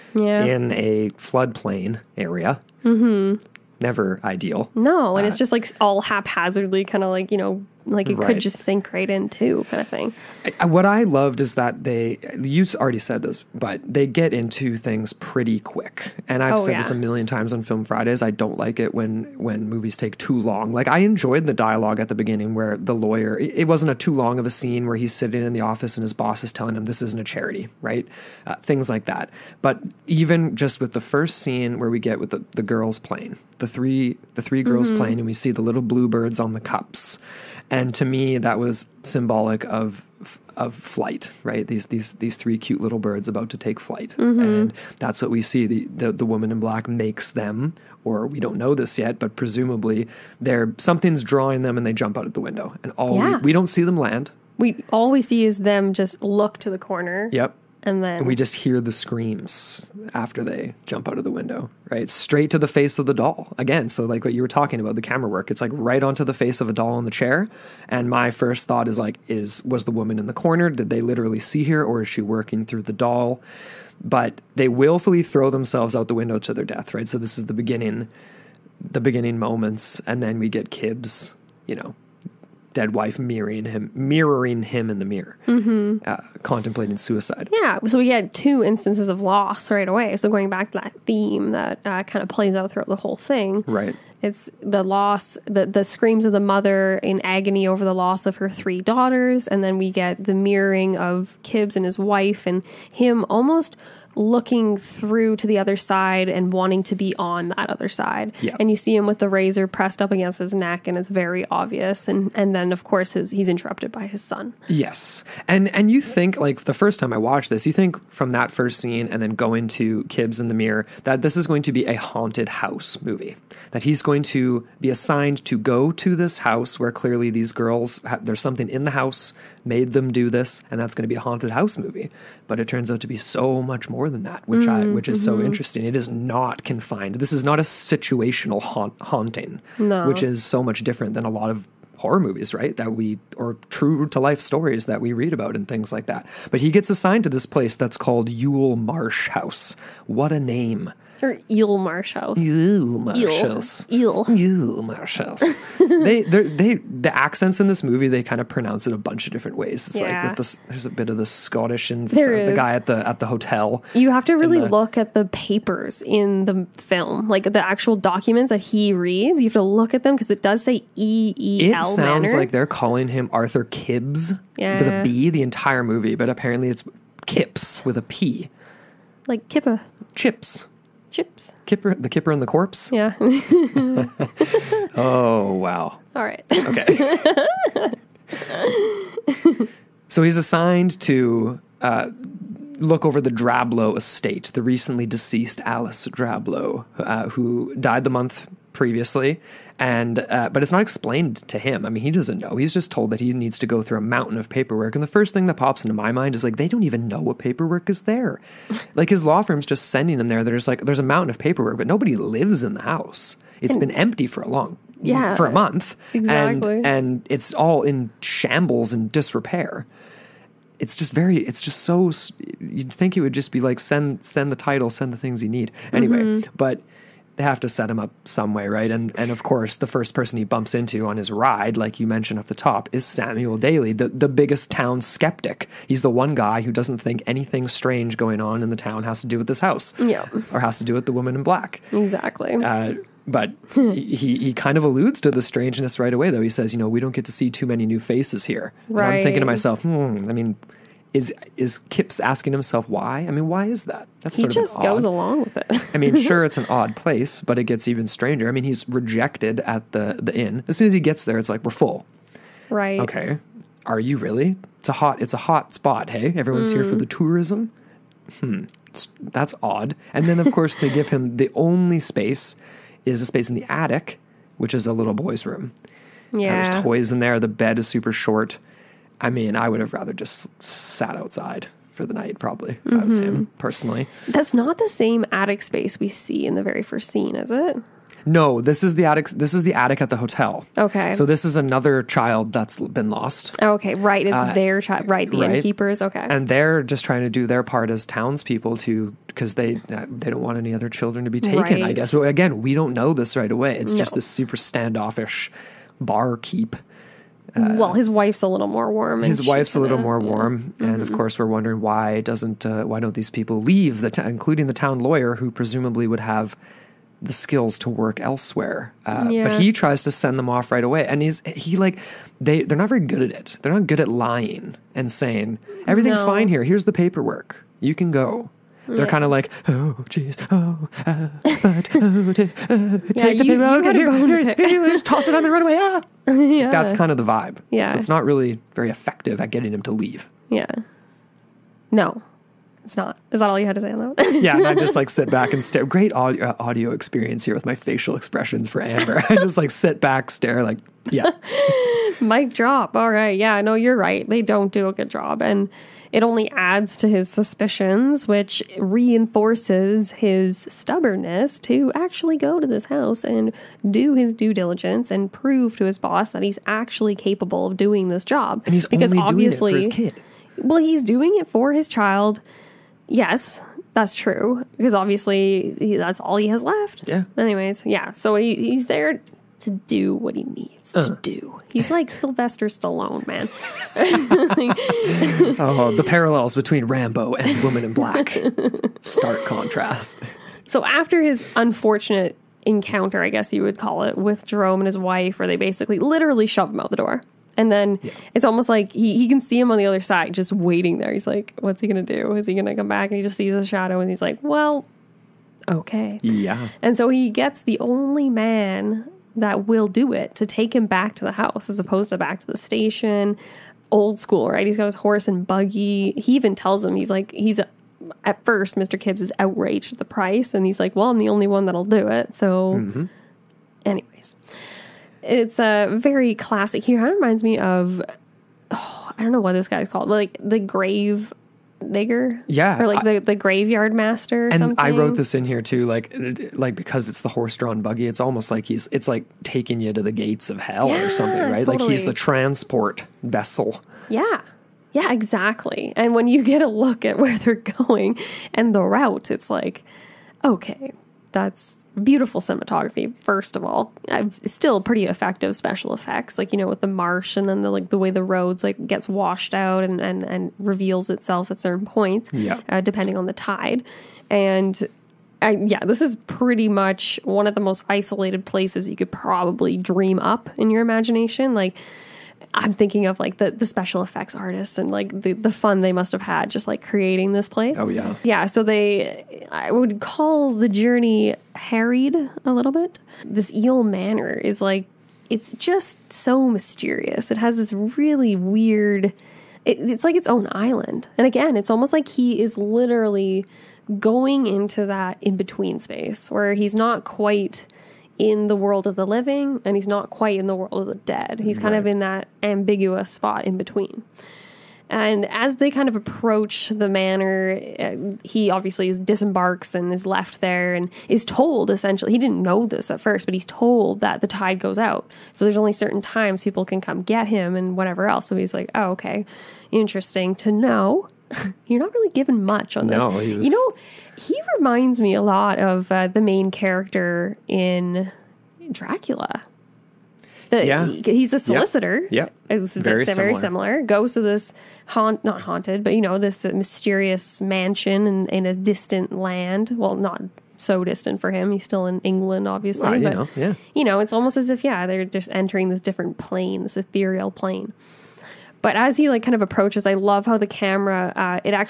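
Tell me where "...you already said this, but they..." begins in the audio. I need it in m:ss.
0:12.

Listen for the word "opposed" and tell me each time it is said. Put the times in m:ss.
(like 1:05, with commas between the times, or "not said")
6:51.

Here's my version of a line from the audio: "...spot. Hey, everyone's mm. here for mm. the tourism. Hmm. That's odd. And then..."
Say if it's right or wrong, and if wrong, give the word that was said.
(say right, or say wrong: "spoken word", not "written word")
right.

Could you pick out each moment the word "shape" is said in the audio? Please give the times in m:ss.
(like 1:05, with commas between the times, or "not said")
not said.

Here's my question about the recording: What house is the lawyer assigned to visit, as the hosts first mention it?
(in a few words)
Yule Marsh House.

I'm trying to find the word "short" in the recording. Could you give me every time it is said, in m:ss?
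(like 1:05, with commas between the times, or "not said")
4:38.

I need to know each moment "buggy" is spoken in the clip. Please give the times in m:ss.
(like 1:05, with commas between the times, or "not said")
6:55, 7:17.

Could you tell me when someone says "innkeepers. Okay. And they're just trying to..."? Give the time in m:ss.
4:55.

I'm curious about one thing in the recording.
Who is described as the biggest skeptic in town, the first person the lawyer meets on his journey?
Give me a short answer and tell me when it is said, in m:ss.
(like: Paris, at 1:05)
Samuel Daly, at 3:53.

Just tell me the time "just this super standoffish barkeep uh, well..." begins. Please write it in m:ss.
5:03.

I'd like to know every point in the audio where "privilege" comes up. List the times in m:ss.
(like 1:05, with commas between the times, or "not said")
not said.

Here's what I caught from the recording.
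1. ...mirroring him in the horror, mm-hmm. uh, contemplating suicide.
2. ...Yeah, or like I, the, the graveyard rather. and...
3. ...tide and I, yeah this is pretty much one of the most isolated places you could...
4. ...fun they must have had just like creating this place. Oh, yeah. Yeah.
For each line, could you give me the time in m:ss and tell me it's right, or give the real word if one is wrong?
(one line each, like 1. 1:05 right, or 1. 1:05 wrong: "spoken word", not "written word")
1. 1:23 wrong: "mirror", not "horror"
2. 7:12 wrong: "master", not "rather"
3. 7:43 right
4. 7:55 right.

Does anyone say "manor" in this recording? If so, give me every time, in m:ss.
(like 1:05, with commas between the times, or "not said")
8:03, 8:26.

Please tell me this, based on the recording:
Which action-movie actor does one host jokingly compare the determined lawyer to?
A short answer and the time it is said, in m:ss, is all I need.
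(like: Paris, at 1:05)
Sylvester Stallone, at 6:22.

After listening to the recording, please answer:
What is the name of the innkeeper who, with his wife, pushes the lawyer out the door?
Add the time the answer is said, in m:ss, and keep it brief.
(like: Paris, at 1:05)
Jerome, at 6:34.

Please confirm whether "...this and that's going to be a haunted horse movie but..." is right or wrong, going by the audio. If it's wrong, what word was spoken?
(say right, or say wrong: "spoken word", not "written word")
wrong: "house", not "horse".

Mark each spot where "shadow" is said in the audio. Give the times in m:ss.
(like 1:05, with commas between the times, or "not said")
6:43.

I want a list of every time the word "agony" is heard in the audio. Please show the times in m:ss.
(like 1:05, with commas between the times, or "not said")
1:37.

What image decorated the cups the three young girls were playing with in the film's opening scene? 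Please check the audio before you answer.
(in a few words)
Bluebirds.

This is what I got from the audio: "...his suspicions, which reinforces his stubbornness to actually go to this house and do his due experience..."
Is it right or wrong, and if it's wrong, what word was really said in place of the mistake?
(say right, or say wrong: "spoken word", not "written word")
wrong: "diligence", not "experience".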